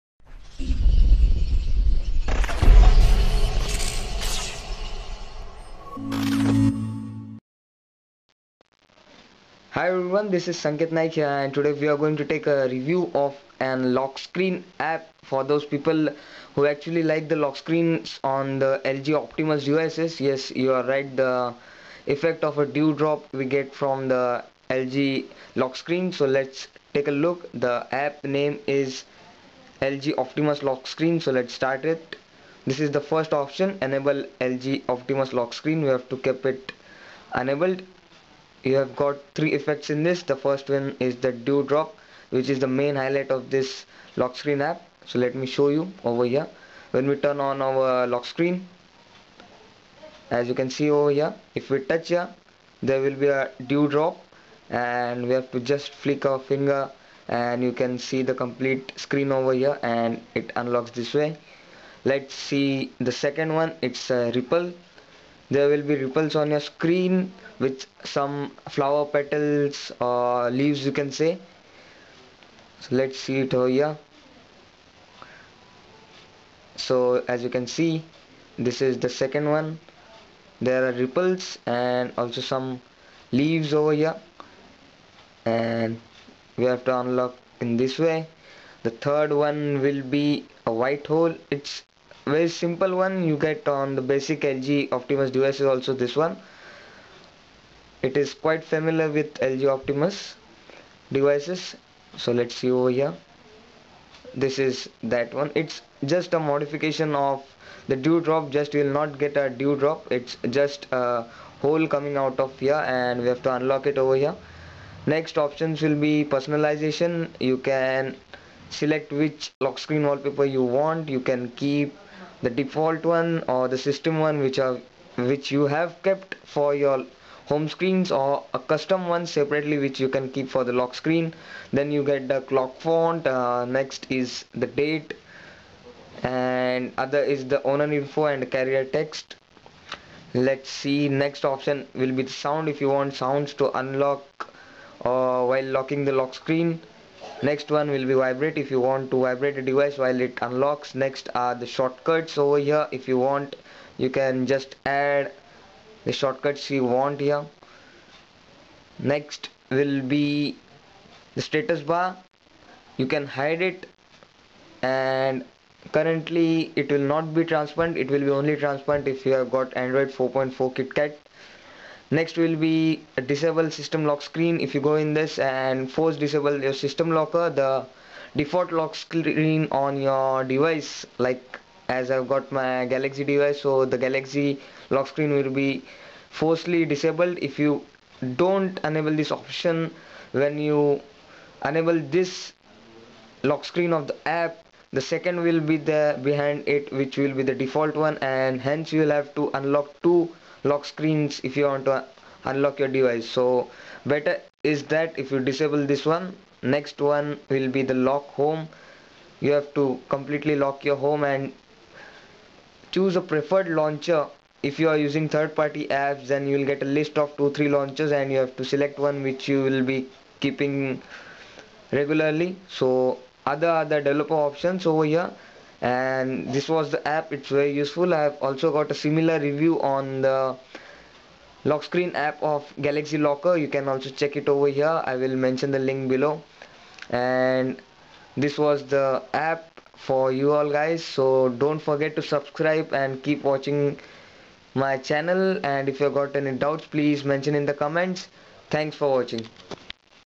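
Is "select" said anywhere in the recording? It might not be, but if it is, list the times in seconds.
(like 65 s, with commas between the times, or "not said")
118 s, 218 s.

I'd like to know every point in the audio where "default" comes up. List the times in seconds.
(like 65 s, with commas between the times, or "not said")
122 s, 178 s, 197 s.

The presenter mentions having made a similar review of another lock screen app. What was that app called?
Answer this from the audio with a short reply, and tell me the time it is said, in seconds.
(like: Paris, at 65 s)
Galaxy Locker, at 232 s.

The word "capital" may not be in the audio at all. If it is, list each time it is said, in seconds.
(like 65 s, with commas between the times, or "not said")
not said.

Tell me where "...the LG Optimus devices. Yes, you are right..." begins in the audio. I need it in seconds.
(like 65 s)
18 s.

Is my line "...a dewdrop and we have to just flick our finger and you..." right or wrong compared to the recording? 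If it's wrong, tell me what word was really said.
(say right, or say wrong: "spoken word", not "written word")
right.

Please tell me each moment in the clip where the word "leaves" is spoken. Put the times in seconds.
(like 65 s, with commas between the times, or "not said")
70 s, 83 s.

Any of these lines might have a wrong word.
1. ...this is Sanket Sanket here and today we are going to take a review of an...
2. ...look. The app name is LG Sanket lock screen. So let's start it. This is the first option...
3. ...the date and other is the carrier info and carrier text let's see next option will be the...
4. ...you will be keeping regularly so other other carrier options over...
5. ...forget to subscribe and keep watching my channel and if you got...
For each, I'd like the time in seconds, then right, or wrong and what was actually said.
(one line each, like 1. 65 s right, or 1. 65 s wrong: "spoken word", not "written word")
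1. 10 s wrong: "Naik", not "Sanket"
2. 27 s wrong: "Optimus", not "Sanket"
3. 134 s wrong: "owner", not "carrier"
4. 219 s wrong: "developer", not "carrier"
5. 241 s right.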